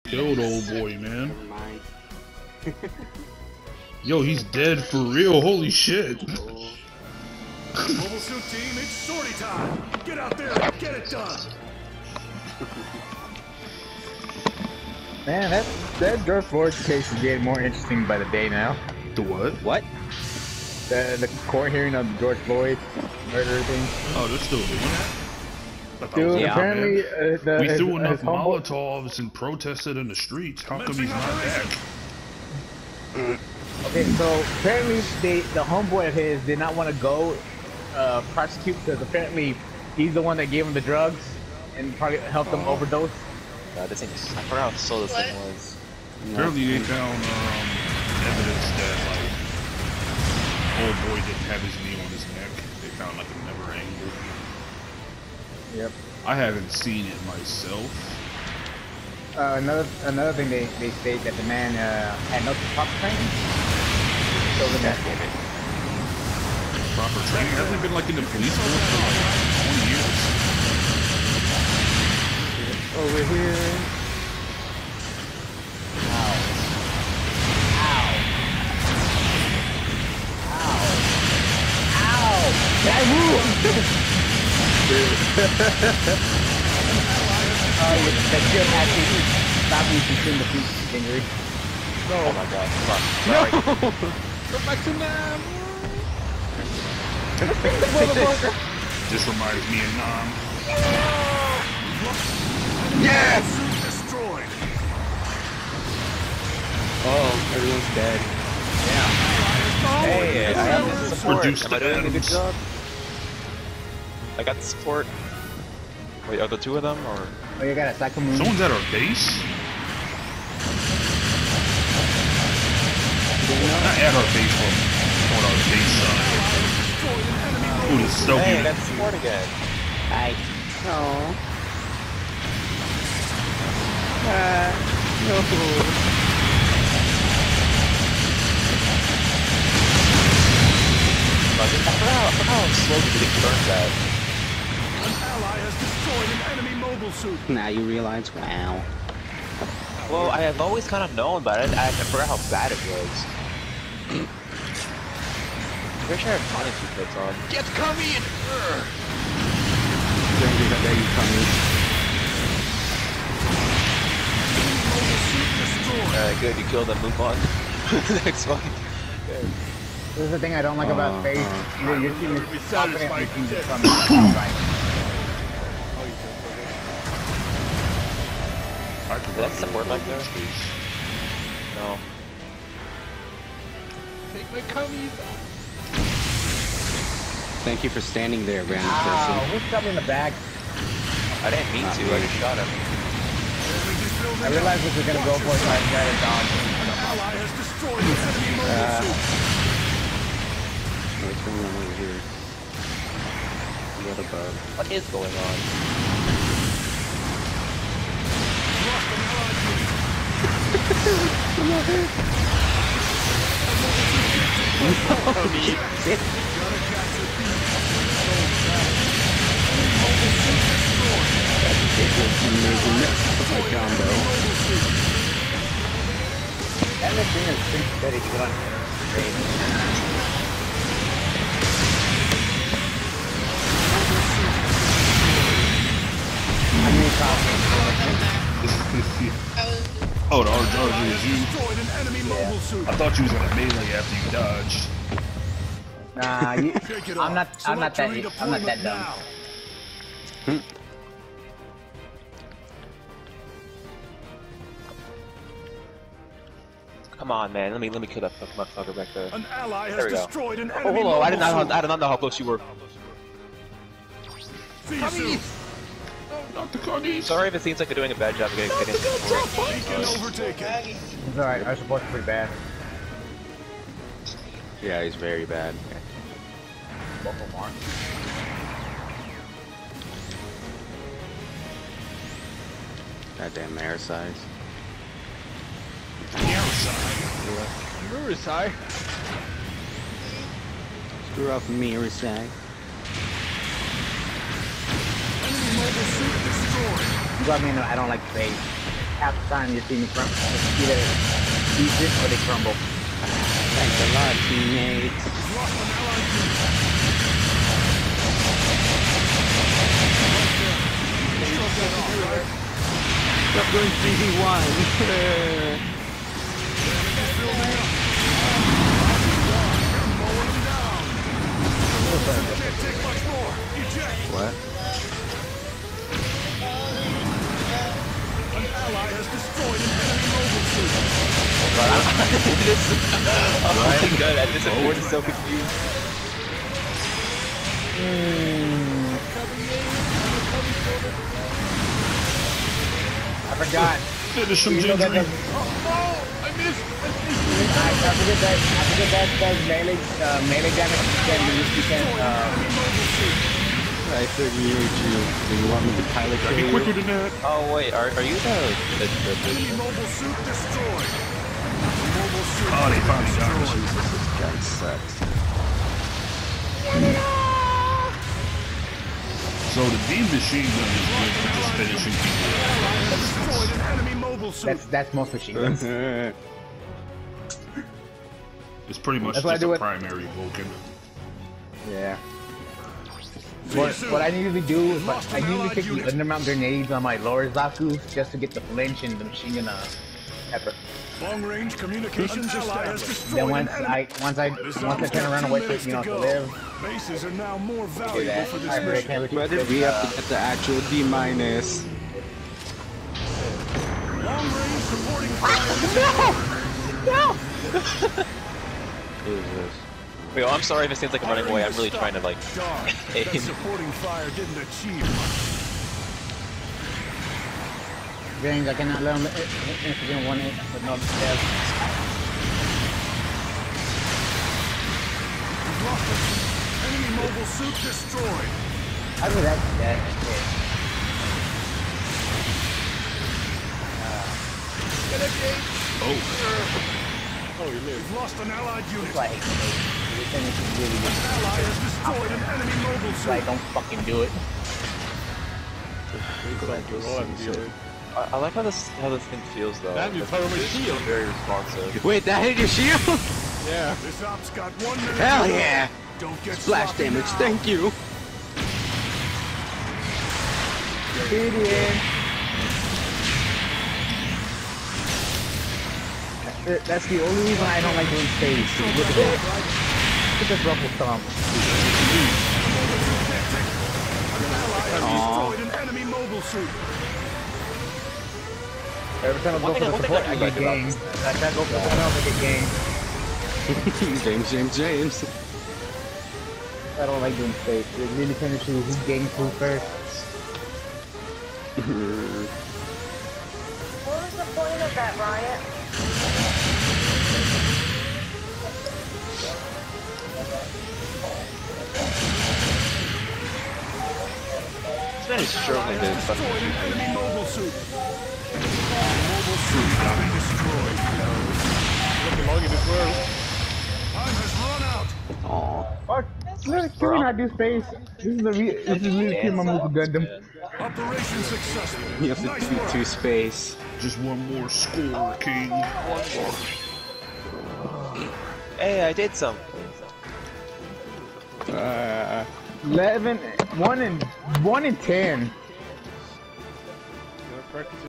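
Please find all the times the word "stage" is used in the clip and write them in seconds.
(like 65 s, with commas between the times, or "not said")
468 s.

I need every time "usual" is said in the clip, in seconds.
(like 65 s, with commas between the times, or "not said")
not said.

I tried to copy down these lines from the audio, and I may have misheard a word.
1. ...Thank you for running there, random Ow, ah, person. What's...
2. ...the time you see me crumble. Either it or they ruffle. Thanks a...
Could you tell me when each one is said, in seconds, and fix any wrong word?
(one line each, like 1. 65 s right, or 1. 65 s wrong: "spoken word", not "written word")
1. 187 s wrong: "standing", not "running"
2. 299 s wrong: "crumble", not "ruffle".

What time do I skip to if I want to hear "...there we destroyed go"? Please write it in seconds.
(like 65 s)
259 s.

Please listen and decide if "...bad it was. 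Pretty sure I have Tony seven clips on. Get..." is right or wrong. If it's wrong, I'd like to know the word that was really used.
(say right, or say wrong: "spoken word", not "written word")
wrong: "two", not "seven".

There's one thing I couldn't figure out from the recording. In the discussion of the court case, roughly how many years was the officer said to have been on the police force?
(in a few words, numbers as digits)
20.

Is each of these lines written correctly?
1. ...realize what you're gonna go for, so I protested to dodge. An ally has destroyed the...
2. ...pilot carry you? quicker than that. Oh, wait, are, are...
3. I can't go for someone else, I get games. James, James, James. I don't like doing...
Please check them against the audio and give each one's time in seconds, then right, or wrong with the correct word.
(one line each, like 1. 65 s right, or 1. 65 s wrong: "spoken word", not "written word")
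1. 194 s wrong: "tried", not "protested"
2. 356 s right
3. 481 s right.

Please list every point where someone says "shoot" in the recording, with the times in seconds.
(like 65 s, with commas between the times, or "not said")
507 s.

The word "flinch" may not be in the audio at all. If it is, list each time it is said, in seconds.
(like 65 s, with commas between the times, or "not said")
388 s.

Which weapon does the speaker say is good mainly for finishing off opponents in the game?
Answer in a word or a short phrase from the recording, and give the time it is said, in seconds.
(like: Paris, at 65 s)
beam machine gun, at 370 s.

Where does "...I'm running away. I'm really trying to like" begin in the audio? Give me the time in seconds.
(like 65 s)
411 s.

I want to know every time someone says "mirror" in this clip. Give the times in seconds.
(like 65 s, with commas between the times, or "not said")
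286 s, 291 s.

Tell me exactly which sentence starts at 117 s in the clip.
Oh, you got a second moon.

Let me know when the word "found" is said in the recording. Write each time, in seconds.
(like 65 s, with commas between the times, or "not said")
46 s, 52 s.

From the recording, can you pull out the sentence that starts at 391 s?
Long range communications Then once I once I once I turn around and wait for you know to live.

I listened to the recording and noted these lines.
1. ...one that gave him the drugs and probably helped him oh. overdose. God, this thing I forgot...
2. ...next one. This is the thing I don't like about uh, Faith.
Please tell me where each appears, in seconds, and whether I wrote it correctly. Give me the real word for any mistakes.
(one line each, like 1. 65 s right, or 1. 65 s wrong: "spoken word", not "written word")
1. 40 s right
2. 168 s right.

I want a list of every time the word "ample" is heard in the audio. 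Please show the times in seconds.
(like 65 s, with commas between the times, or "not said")
not said.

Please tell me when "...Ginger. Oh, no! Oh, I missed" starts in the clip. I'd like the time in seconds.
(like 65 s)
344 s.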